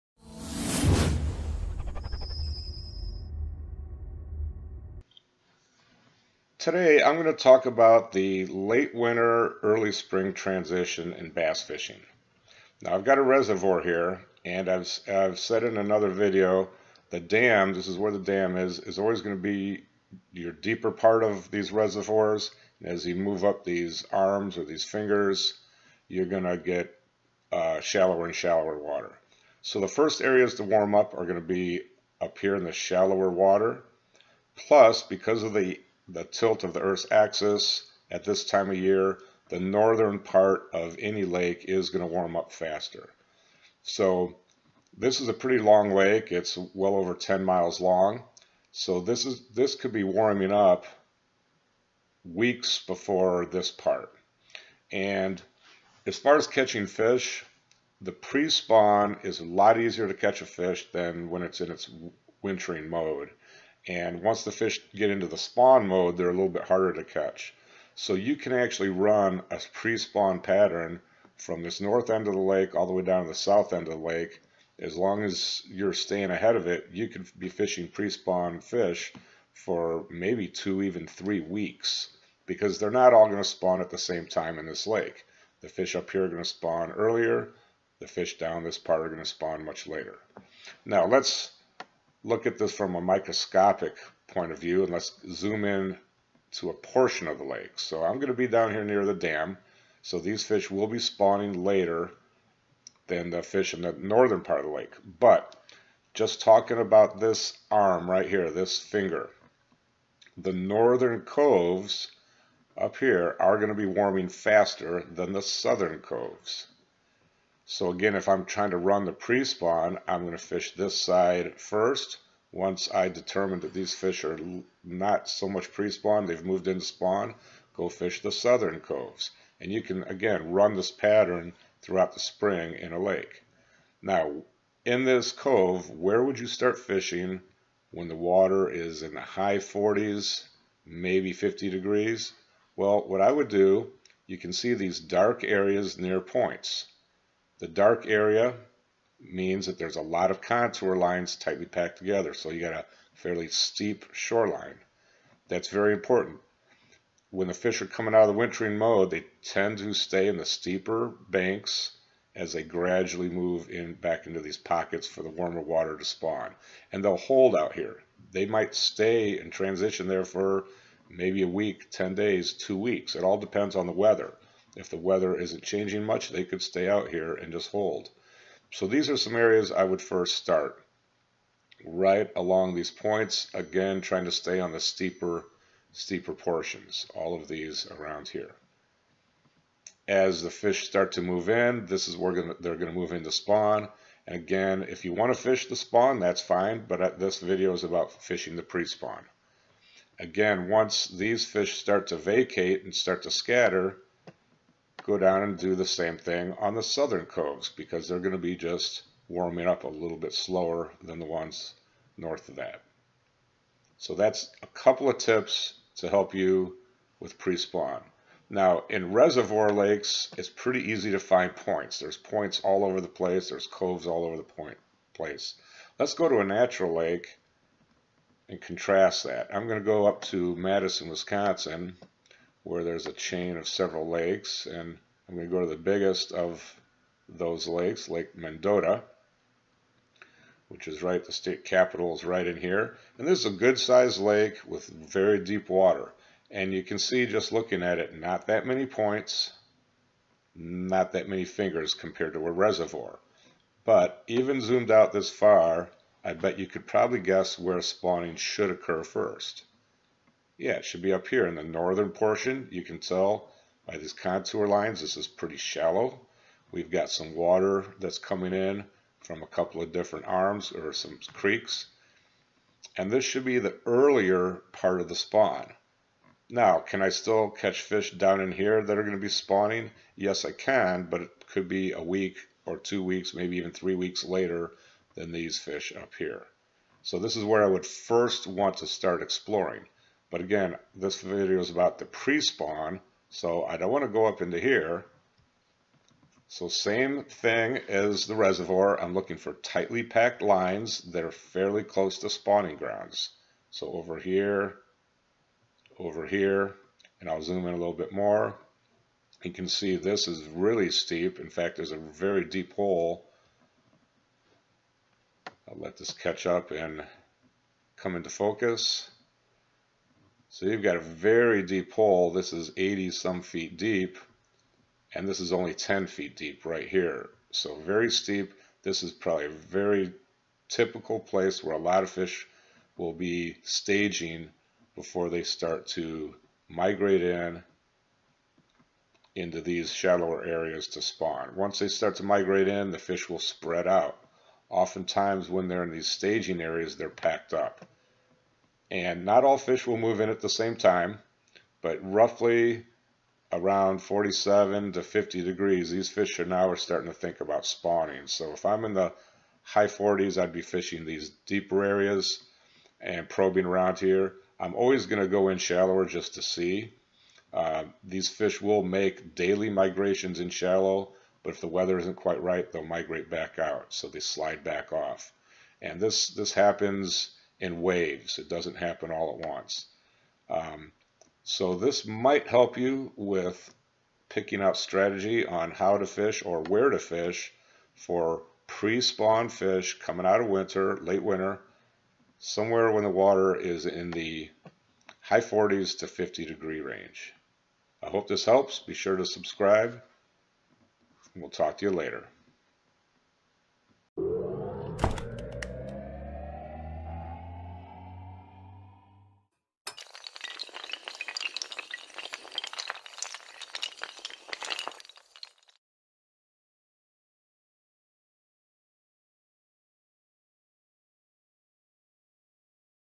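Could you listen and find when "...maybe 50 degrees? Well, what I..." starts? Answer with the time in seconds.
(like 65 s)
140 s.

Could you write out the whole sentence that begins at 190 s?
As the fish start to move in, this is where they're going to move into spawn.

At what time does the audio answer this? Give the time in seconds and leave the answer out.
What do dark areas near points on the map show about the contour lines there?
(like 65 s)
151 s.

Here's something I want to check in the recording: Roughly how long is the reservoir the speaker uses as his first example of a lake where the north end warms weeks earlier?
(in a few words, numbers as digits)
over 10 miles.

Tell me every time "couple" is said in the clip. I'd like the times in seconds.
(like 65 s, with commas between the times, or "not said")
214 s, 269 s.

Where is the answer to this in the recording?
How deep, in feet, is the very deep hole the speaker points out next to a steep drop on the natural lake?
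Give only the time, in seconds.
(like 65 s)
322 s.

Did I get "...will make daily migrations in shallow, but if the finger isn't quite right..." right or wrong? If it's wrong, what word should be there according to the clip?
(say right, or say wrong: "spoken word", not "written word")
wrong: "weather", not "finger".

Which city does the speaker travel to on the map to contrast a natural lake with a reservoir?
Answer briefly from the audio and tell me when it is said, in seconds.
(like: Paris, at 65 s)
Madison, Wisconsin, at 230 s.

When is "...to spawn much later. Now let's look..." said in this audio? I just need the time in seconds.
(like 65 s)
89 s.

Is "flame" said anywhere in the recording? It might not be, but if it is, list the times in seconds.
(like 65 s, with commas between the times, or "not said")
not said.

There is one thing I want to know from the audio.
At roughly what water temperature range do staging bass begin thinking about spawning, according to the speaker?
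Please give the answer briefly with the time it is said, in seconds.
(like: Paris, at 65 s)
47 to 50 degrees, at 353 s.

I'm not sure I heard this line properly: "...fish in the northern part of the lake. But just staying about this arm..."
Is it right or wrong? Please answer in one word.
wrong.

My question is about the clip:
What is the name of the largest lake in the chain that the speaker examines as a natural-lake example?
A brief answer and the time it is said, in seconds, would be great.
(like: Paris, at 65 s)
Lake Mendota, at 238 s.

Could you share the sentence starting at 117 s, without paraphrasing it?
So again, if I'm trying to run the pre-spawn, I'm going to fish this side first.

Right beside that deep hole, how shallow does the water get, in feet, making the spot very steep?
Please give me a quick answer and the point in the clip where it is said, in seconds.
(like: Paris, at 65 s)
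10 feet, at 325 s.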